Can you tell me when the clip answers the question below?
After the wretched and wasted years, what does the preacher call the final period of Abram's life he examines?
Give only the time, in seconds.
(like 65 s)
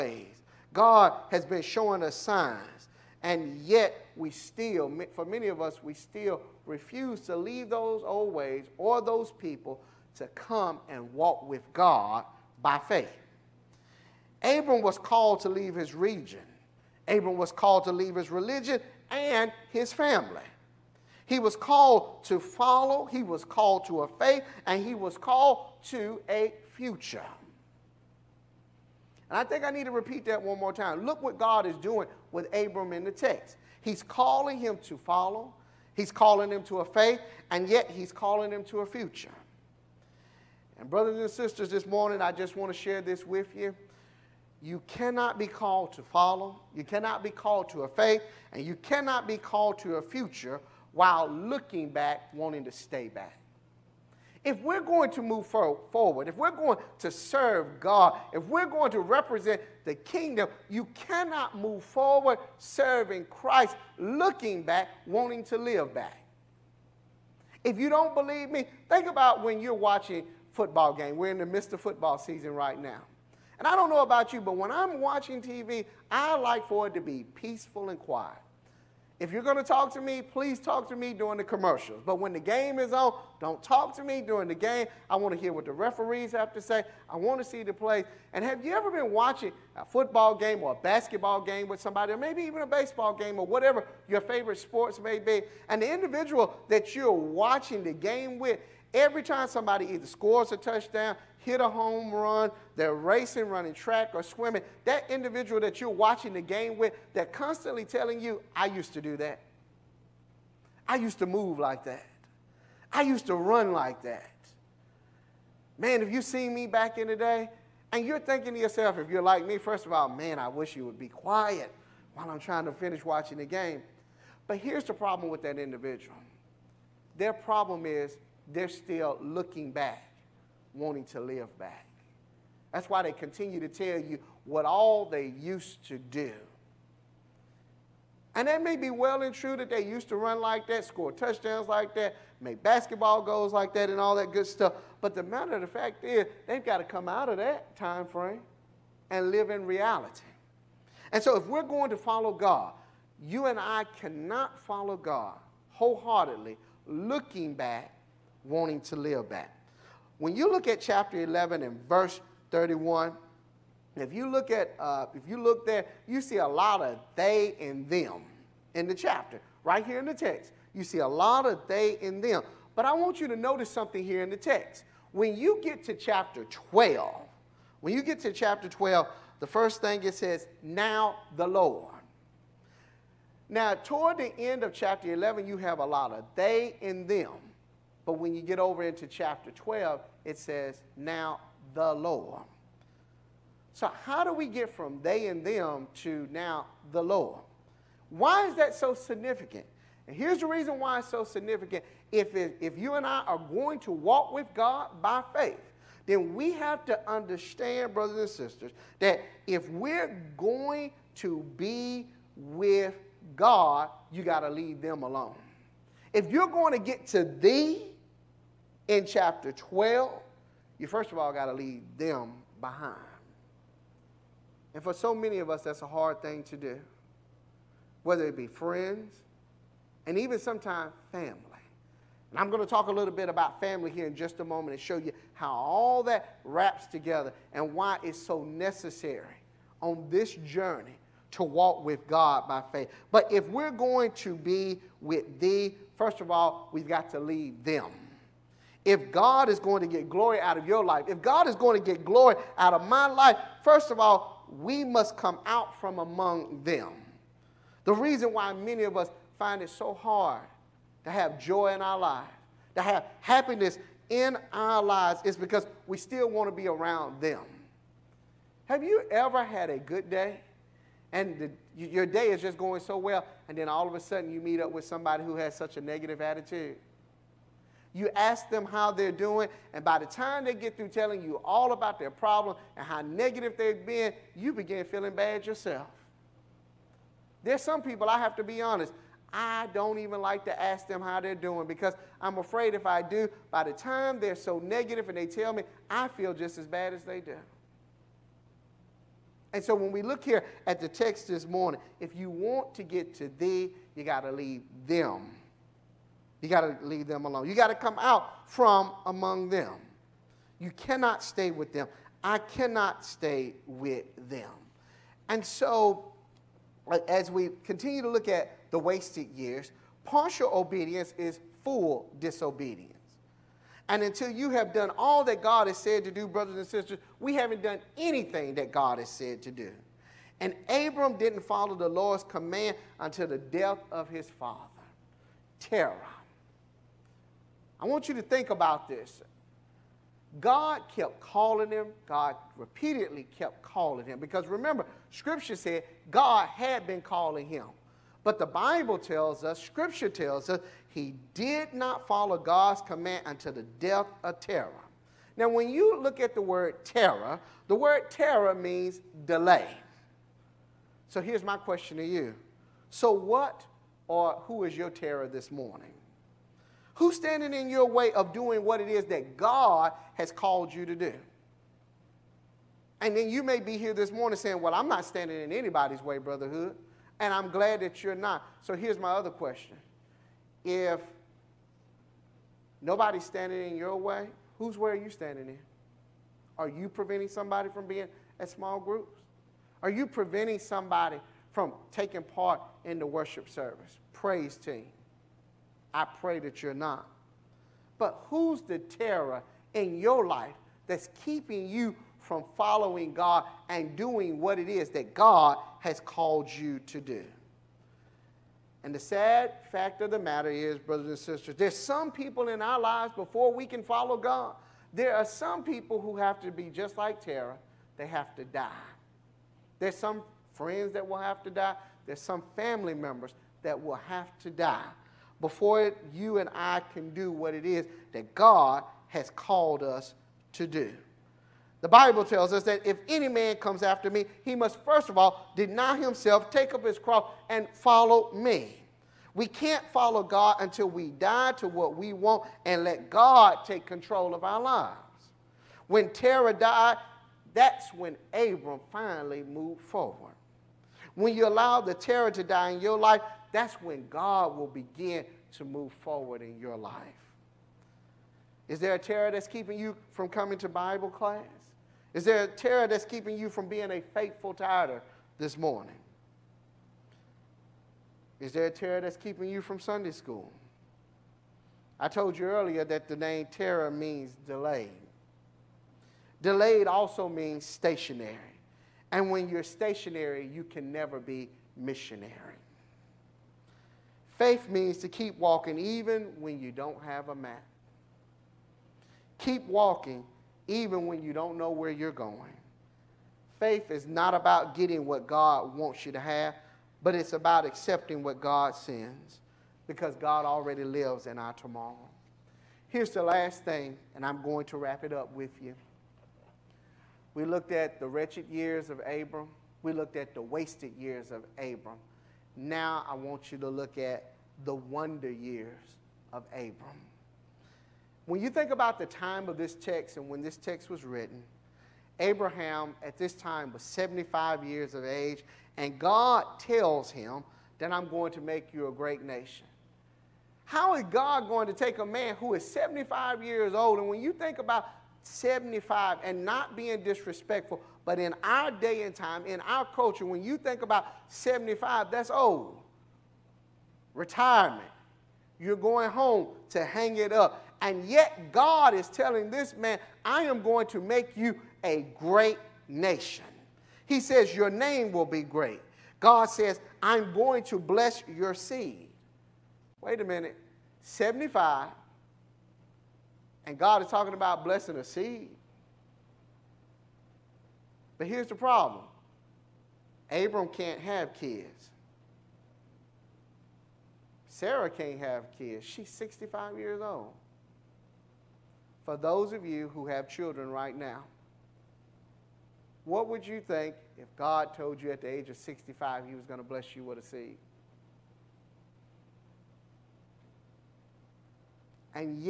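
514 s.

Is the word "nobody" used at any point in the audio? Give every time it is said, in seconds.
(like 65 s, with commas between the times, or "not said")
382 s.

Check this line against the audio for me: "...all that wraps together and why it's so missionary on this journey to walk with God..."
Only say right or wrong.
wrong.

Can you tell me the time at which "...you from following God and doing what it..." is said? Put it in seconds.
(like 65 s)
401 s.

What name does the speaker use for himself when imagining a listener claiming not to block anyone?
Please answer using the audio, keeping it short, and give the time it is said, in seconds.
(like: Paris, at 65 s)
Brother Hood, at 376 s.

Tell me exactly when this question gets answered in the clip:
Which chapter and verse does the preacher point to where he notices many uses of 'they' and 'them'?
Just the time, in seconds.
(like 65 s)
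160 s.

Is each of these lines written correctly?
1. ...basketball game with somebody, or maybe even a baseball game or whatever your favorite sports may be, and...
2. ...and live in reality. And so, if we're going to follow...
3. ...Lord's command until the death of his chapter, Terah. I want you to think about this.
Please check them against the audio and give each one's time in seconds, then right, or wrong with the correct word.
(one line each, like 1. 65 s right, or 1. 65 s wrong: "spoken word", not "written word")
1. 90 s right
2. 149 s right
3. 331 s wrong: "father", not "chapter".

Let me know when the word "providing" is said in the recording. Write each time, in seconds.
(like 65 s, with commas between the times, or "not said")
not said.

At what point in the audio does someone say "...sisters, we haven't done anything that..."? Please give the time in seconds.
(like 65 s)
326 s.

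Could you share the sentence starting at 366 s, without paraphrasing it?
Who's standing in your way of doing what it is that God has called you to do?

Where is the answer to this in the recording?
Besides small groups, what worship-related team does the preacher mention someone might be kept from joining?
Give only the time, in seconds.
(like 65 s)
394 s.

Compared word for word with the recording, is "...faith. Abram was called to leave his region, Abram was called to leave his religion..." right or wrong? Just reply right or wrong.
right.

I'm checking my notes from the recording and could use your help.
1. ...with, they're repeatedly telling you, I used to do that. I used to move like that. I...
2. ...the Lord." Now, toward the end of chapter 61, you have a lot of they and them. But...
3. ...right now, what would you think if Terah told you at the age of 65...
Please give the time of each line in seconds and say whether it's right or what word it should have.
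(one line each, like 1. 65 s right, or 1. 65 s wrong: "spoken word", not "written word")
1. 106 s wrong: "constantly", not "repeatedly"
2. 181 s wrong: "11", not "61"
3. 580 s wrong: "God", not "Terah".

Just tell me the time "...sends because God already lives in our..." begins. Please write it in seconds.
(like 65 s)
498 s.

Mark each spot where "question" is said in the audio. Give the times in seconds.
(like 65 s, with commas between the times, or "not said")
361 s, 379 s.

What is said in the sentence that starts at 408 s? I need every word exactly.
And the sad fact of the matter is, brothers and sisters, there's some people in our lives before we can follow God.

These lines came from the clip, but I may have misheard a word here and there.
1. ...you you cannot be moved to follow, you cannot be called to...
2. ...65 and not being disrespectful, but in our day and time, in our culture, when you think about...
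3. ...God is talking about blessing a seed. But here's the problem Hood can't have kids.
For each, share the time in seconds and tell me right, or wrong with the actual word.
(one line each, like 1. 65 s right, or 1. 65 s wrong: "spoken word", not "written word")
1. 43 s wrong: "called", not "moved"
2. 535 s wrong: "75", not "65"
3. 563 s wrong: "Abram", not "Hood".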